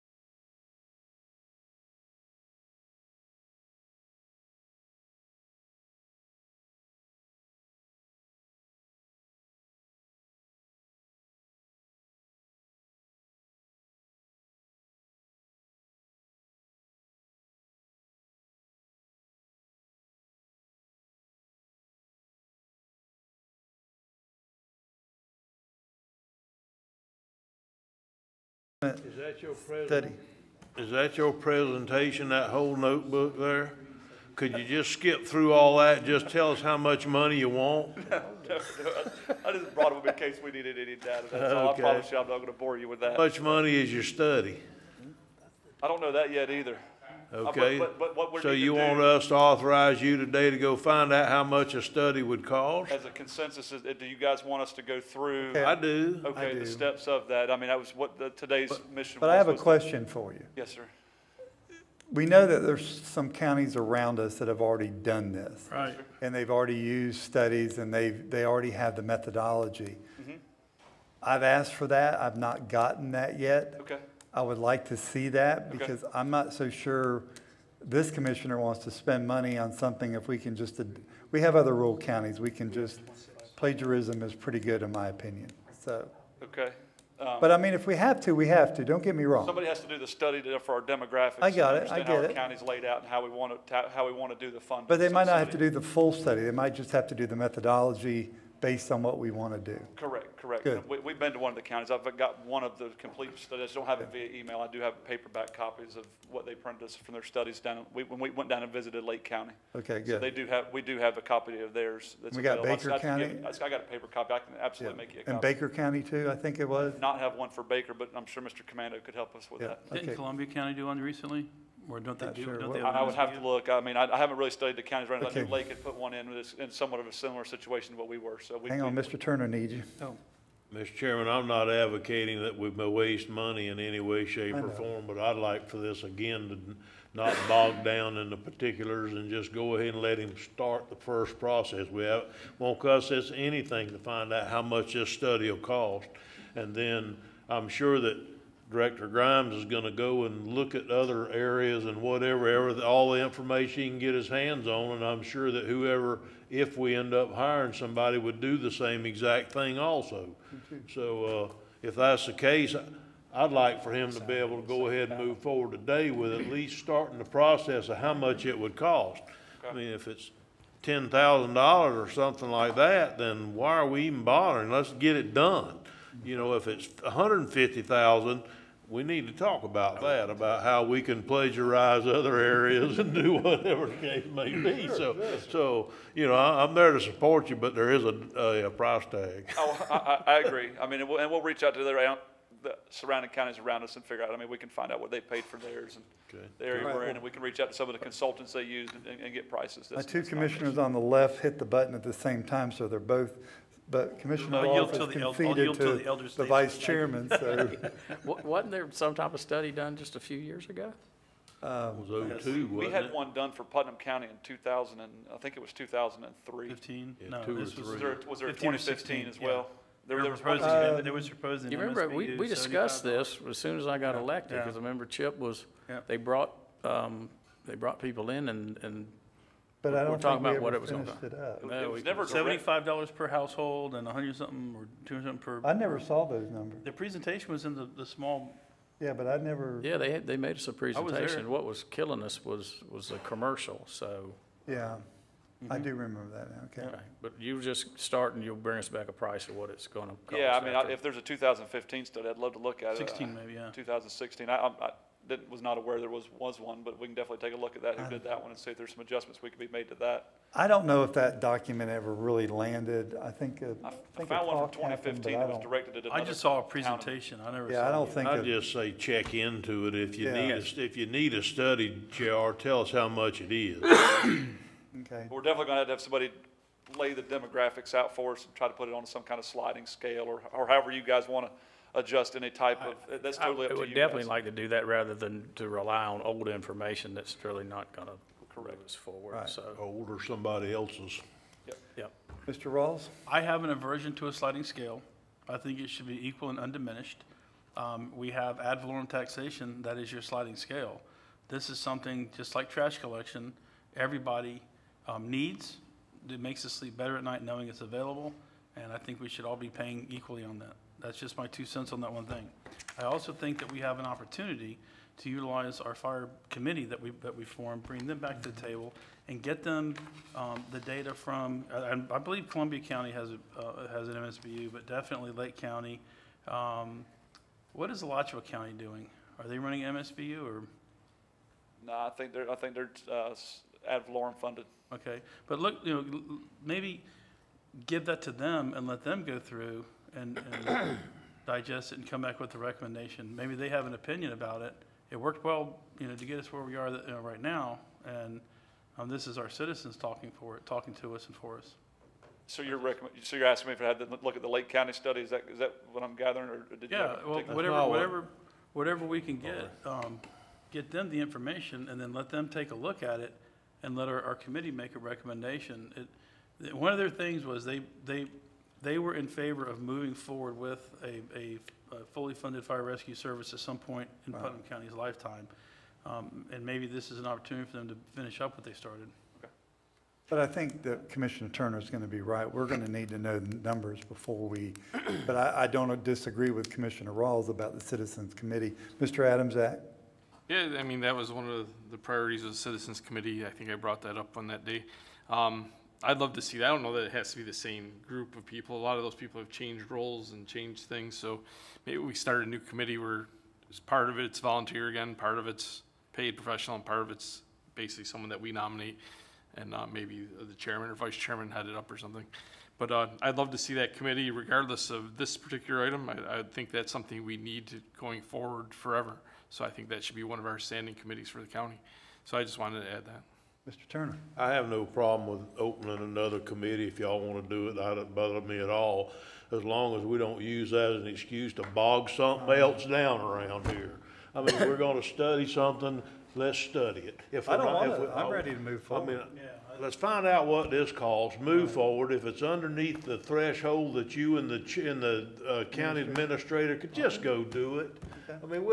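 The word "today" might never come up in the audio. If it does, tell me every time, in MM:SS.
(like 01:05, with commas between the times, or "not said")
00:50, 00:58, 02:45.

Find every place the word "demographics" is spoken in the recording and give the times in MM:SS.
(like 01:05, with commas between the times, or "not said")
01:30, 04:37.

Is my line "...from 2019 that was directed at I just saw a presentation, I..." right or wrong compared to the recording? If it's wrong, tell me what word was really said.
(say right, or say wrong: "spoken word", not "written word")
wrong: "2015", not "2019".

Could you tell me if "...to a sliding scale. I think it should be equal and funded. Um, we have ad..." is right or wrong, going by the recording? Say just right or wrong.
wrong.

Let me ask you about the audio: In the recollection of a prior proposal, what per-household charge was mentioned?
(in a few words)
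$75.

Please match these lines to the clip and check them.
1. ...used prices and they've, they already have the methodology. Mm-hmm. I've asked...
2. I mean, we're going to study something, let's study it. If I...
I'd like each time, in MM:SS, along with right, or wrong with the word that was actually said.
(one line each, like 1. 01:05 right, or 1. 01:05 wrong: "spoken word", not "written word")
1. 01:06 wrong: "studies", not "prices"
2. 07:14 right.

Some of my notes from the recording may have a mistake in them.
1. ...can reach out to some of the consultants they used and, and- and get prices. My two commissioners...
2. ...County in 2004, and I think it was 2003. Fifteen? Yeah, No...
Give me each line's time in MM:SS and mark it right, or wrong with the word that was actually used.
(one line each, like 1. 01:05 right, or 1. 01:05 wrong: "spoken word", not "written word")
1. 03:17 right
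2. 03:33 wrong: "2000", not "2004".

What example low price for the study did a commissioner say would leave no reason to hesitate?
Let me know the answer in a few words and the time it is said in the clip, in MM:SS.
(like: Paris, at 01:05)
$10,000, at 02:50.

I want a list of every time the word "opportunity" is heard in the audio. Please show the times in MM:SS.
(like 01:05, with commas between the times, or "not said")
05:14, 06:17.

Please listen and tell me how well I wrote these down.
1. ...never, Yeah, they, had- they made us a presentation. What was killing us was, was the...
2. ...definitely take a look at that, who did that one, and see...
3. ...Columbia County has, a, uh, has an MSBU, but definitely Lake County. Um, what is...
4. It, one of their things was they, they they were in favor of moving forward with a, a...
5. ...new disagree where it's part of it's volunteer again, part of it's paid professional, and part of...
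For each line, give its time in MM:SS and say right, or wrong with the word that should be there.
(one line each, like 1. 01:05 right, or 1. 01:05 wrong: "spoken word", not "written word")
1. 03:59 right
2. 04:17 right
3. 05:22 right
4. 06:05 right
5. 06:42 wrong: "committee", not "disagree".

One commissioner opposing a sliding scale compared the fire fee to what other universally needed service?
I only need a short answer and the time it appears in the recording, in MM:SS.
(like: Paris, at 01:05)
Trash collection, at 05:02.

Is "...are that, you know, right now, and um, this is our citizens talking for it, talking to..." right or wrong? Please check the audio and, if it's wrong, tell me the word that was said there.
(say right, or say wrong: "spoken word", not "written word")
right.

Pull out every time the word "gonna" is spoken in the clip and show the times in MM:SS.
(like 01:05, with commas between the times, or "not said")
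00:42, 02:29, 03:50, 04:09, 04:35.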